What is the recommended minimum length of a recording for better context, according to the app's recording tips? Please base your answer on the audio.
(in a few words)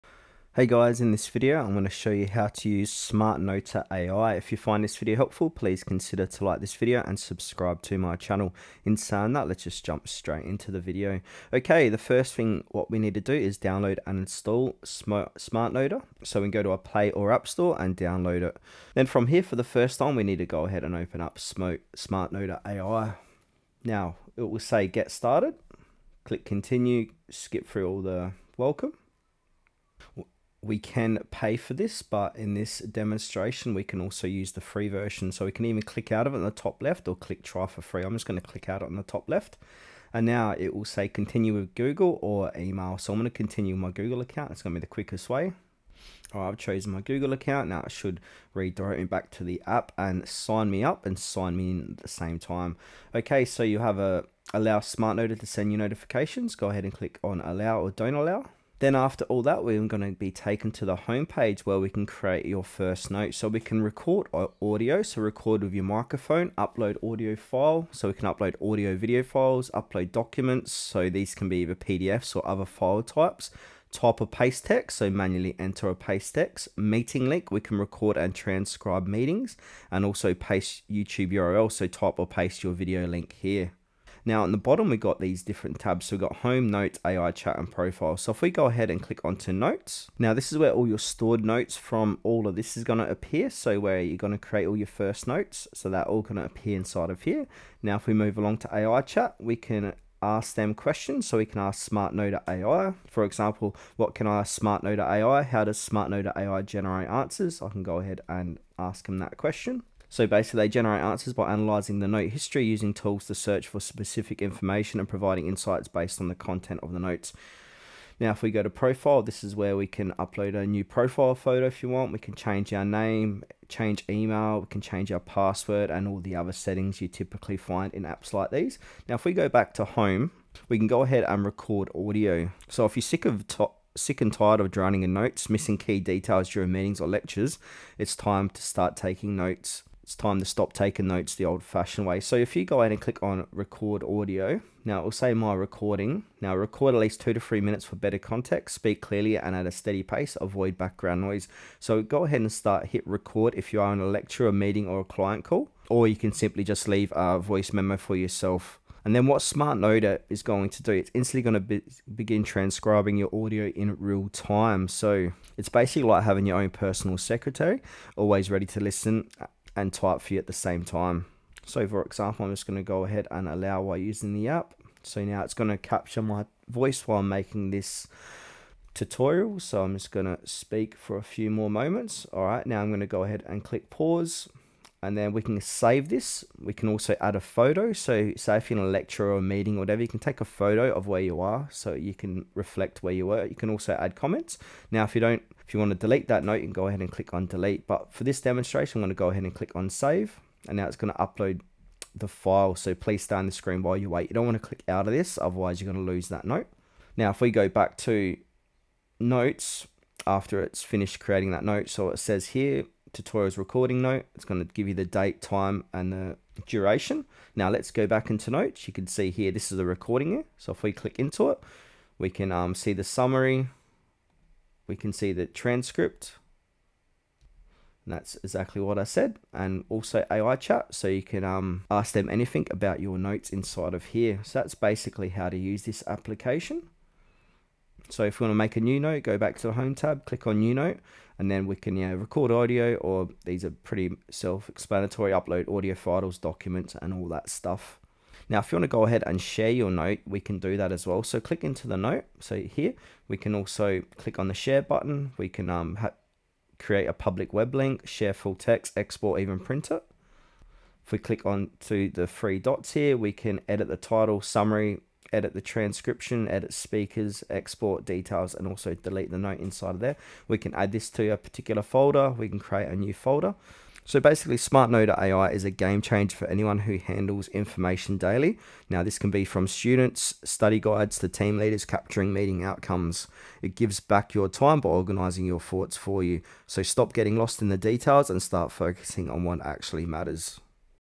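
2 to 3 minutes.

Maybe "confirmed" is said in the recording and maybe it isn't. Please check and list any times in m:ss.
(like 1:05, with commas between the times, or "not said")
not said.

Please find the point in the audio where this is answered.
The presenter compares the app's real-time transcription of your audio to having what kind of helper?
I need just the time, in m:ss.
2:46.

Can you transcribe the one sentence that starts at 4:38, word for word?
Now, this can be from students, study guides, to team leaders capturing meeting outcomes.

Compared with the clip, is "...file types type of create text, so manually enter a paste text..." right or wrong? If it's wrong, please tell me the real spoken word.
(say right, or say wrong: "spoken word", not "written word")
wrong: "paste", not "create".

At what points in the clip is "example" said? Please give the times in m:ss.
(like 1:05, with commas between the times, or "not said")
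1:43, 2:52.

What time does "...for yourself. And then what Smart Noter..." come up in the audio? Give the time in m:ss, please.
2:37.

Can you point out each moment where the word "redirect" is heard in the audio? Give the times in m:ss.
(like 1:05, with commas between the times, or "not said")
0:48.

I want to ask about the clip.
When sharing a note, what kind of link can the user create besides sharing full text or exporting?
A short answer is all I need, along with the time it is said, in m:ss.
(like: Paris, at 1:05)
Public web link, at 4:17.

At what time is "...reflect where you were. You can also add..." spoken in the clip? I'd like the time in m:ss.
3:12.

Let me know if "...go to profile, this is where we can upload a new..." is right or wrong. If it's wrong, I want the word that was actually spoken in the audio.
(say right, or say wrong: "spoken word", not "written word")
right.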